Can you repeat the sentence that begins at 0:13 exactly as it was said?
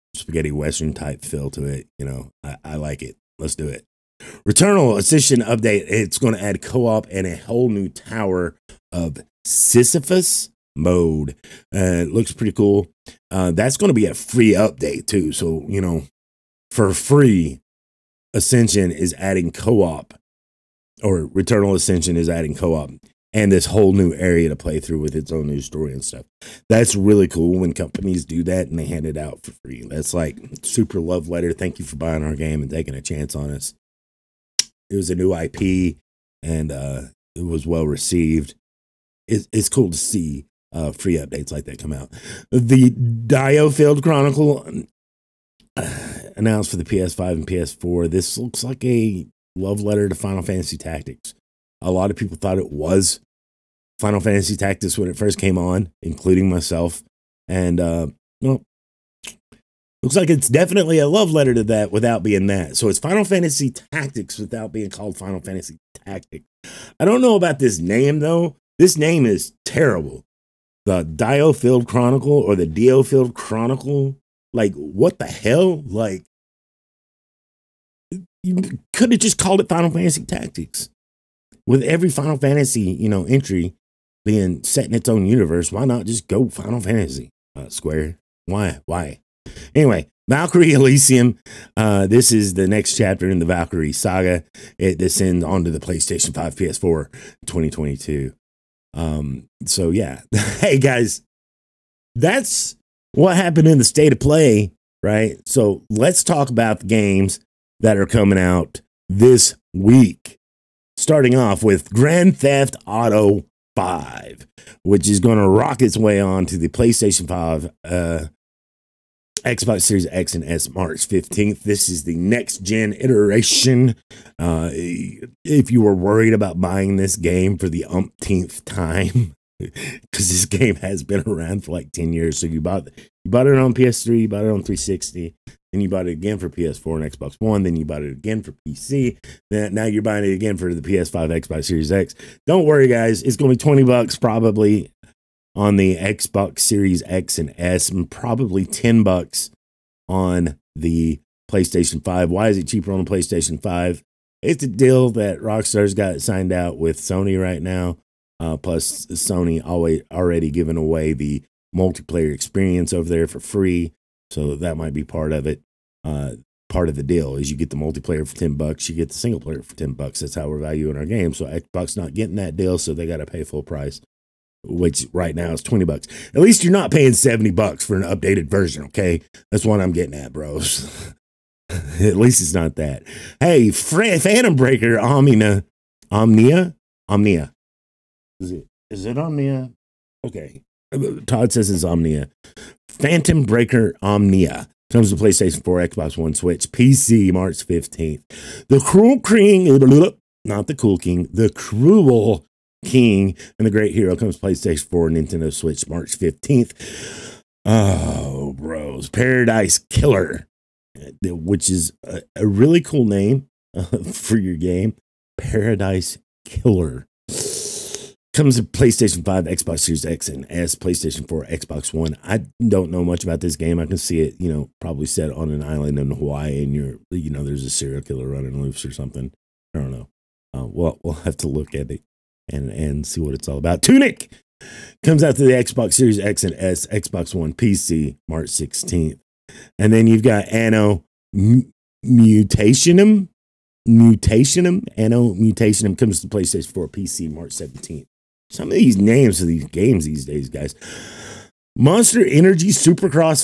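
Uh, that's going to be a free update too.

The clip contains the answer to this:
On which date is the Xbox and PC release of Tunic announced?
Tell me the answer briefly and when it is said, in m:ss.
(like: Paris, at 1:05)
March 16th, at 3:58.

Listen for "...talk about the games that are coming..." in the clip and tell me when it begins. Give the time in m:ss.
1:46.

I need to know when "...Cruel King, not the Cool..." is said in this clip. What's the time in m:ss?
3:18.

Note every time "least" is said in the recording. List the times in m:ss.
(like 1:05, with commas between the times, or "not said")
2:56, 3:02.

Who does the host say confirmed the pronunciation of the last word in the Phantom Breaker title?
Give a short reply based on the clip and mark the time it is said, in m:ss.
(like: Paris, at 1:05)
Todd, at 3:11.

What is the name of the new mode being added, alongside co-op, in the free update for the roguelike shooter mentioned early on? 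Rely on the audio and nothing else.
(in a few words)
Tower of Sisyphus.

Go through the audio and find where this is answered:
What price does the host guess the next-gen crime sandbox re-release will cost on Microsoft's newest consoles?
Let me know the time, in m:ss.
2:23.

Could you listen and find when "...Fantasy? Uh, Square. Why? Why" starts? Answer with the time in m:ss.
1:26.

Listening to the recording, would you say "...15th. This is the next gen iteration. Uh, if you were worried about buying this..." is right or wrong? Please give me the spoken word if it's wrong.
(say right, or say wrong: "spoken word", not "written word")
right.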